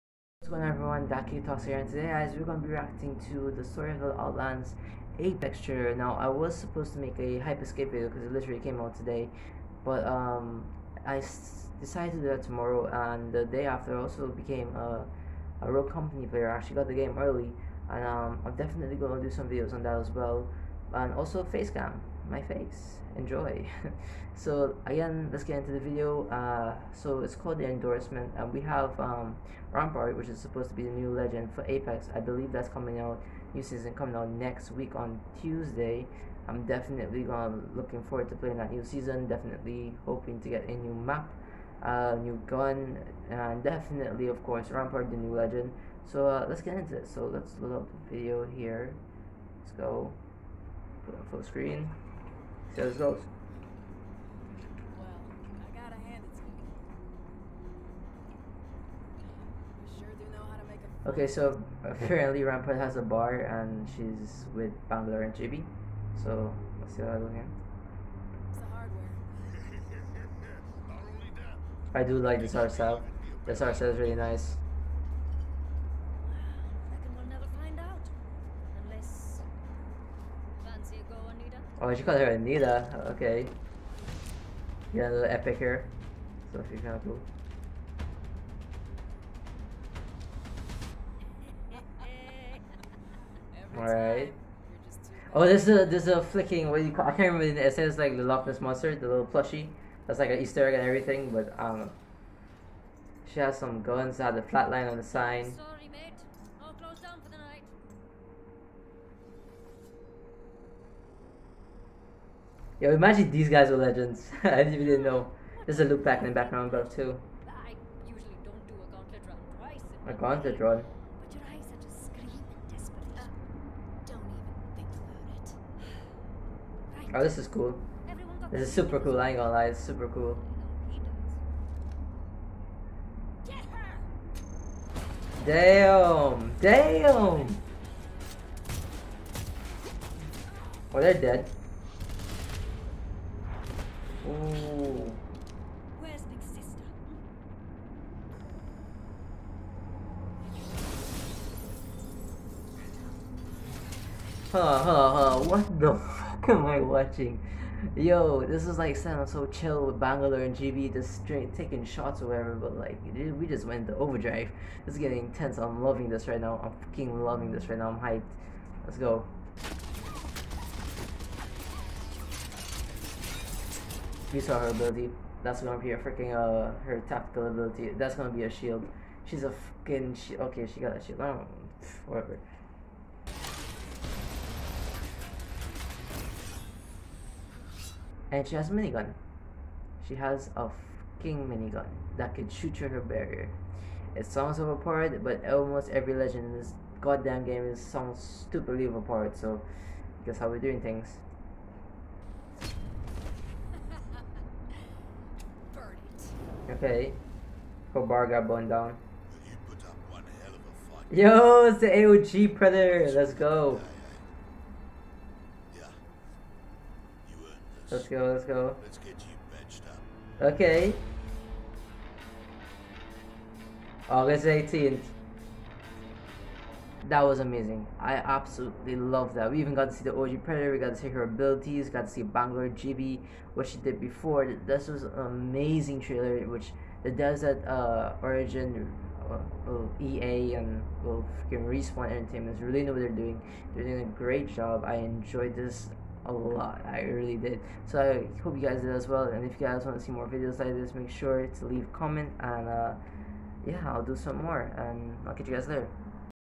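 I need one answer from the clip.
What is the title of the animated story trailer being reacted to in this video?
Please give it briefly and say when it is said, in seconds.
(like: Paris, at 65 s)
The Endorsement, at 27 s.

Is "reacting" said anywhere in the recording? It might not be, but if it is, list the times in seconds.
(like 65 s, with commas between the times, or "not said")
2 s.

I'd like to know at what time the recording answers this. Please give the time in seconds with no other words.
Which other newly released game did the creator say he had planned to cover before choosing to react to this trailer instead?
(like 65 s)
7 s.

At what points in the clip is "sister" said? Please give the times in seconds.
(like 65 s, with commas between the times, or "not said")
146 s.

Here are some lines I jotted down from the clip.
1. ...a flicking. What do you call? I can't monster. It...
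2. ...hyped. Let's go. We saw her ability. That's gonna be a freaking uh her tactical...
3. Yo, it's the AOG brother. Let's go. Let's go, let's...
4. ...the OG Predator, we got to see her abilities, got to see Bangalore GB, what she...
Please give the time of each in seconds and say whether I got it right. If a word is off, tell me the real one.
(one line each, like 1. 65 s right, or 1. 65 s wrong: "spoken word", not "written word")
1. 96 s wrong: "remember", not "monster"
2. 167 s right
3. 211 s right
4. 230 s right.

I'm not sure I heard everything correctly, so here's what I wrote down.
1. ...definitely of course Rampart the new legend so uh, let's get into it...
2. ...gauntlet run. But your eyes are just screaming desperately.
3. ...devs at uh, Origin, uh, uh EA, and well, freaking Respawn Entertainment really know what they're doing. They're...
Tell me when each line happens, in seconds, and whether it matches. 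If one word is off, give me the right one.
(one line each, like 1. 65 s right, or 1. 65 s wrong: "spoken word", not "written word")
1. 43 s right
2. 120 s right
3. 237 s right.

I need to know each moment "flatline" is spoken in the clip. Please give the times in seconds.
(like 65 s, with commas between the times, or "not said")
104 s.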